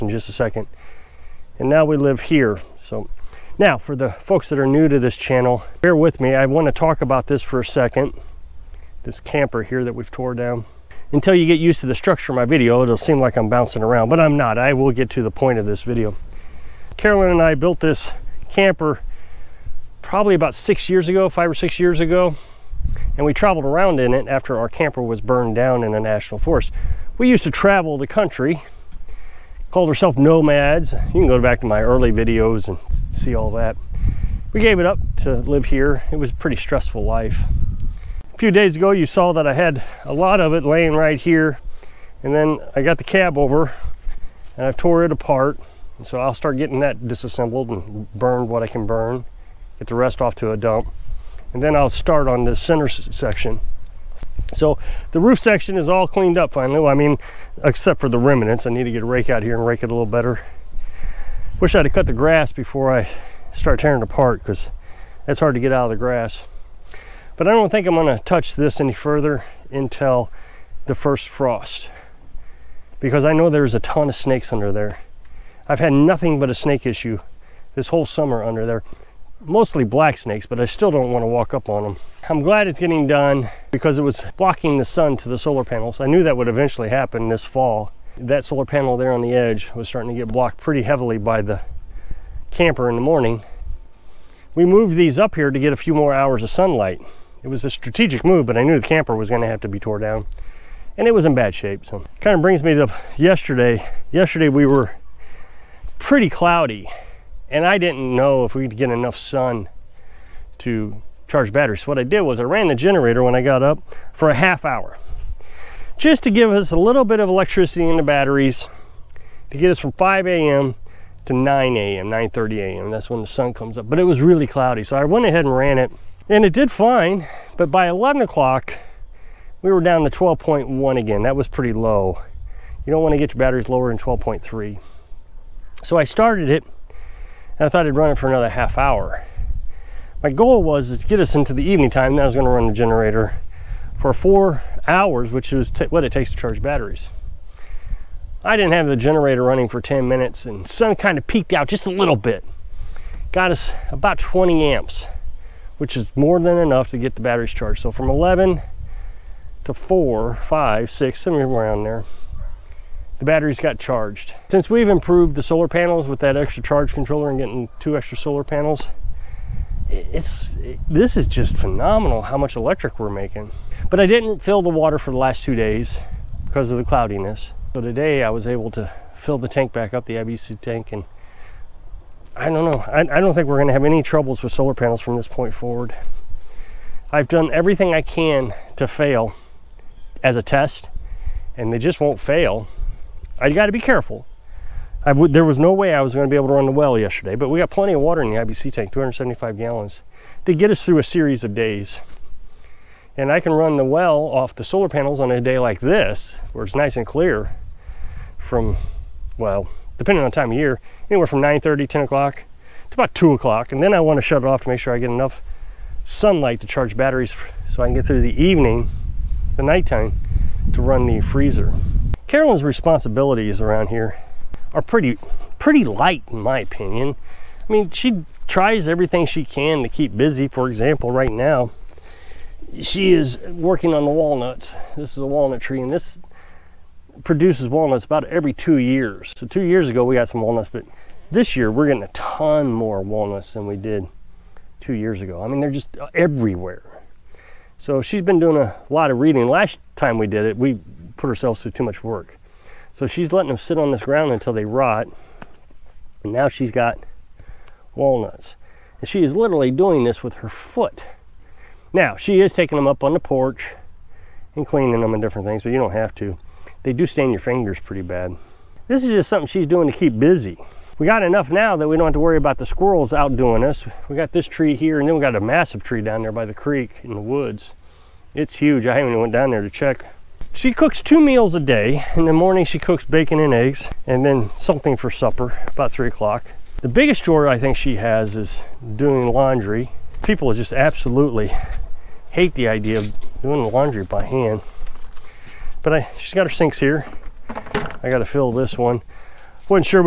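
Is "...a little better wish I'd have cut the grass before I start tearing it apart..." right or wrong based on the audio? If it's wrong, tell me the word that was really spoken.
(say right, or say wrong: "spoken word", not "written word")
right.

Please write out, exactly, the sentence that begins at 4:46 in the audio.
The biggest chore I think she has is doing laundry.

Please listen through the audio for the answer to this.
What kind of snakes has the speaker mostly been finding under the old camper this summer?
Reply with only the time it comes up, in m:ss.
1:19.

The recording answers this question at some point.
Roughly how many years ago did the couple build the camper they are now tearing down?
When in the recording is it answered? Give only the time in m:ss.
0:21.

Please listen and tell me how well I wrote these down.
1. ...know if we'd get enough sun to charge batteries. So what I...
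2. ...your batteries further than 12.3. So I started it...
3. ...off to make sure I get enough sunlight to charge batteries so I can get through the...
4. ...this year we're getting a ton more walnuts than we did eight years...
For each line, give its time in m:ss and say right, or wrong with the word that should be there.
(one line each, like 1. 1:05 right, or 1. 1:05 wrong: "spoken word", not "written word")
1. 1:48 right
2. 2:13 wrong: "lower", not "further"
3. 3:34 right
4. 4:01 wrong: "two", not "eight".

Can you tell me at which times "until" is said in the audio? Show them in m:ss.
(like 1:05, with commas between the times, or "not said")
0:11, 1:09, 4:14.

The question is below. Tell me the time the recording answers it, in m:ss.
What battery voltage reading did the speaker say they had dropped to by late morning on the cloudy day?
2:10.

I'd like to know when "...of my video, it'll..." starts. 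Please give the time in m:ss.
0:12.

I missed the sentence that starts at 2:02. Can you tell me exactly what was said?
That's when the sun comes up.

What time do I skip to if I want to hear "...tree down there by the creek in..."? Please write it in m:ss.
4:35.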